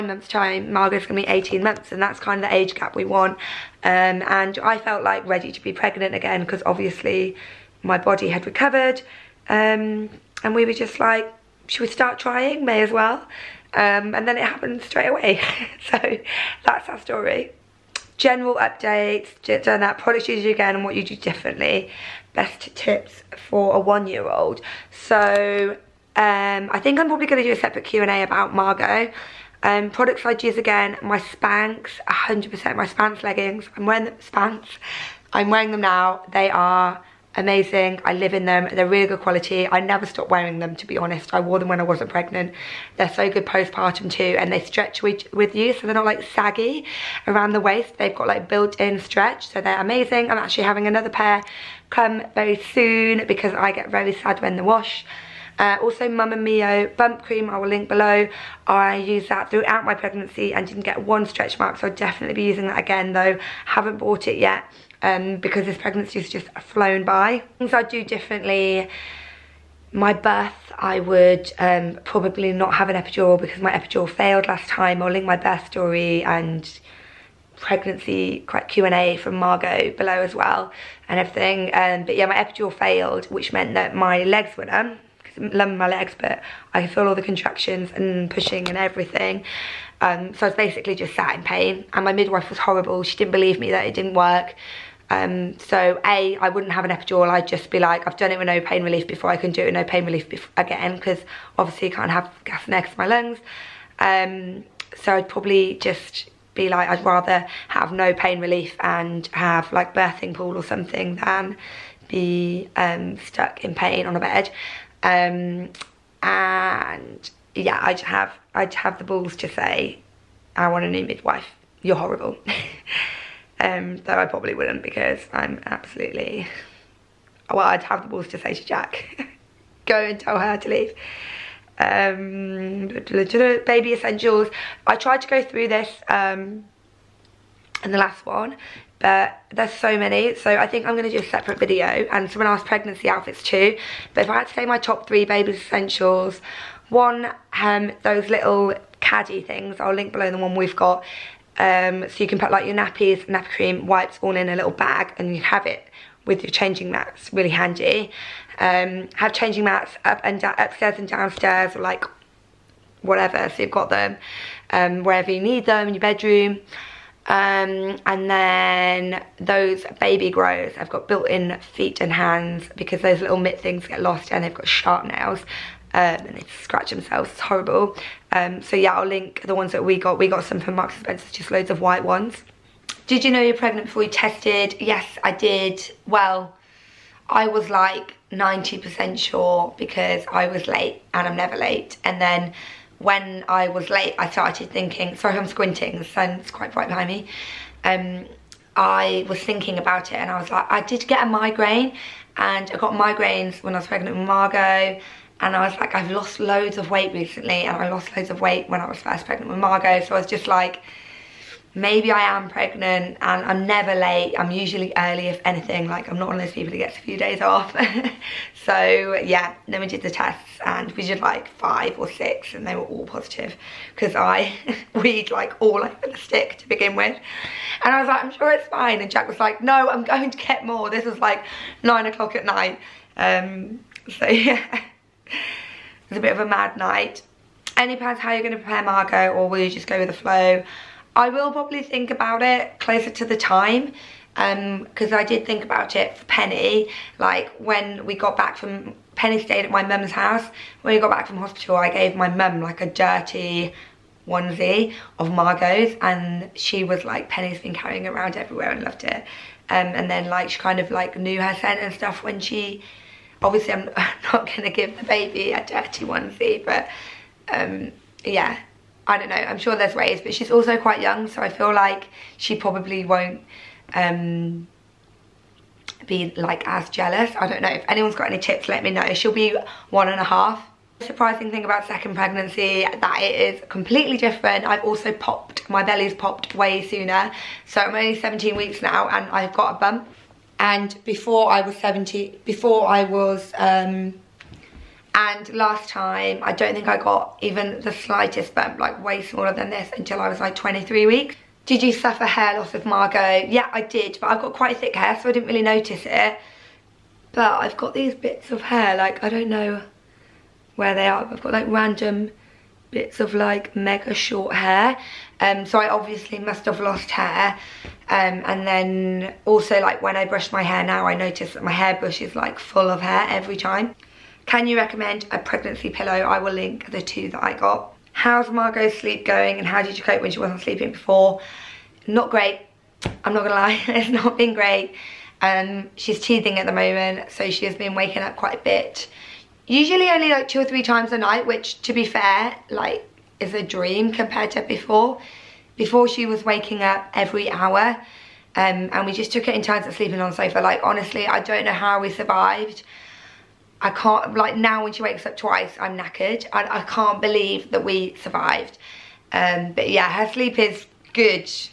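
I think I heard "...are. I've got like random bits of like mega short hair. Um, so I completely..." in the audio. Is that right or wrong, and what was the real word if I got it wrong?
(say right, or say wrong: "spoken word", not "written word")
wrong: "obviously", not "completely".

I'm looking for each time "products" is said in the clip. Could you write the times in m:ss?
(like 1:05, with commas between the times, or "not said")
0:19, 0:29.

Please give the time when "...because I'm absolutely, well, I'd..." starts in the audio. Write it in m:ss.
2:04.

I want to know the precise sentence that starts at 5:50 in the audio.
Like, honestly, I don't know how we survived.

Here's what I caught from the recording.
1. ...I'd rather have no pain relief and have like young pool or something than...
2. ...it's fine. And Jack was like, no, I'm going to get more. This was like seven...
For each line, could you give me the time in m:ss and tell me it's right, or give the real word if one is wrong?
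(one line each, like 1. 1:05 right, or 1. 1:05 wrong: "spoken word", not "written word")
1. 1:46 wrong: "birthing", not "young"
2. 3:48 wrong: "nine", not "seven".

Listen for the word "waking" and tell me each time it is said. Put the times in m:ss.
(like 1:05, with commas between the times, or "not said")
5:37, 5:46.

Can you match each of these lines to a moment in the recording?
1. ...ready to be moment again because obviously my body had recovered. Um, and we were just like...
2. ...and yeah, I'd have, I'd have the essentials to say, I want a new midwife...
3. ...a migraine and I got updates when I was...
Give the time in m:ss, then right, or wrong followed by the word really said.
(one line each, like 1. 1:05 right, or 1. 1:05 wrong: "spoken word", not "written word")
1. 0:05 wrong: "pregnant", not "moment"
2. 1:56 wrong: "balls", not "essentials"
3. 3:21 wrong: "migraines", not "updates".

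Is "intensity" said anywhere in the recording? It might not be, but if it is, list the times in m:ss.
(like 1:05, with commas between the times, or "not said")
not said.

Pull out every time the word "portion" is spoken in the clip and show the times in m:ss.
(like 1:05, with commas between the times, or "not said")
not said.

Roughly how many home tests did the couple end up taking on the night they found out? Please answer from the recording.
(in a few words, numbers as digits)
5 or 6.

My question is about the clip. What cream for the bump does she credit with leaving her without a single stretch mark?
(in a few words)
Mama Mio.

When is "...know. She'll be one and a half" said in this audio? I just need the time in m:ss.
4:38.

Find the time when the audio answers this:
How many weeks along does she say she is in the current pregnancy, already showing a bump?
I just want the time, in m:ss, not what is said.
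4:48.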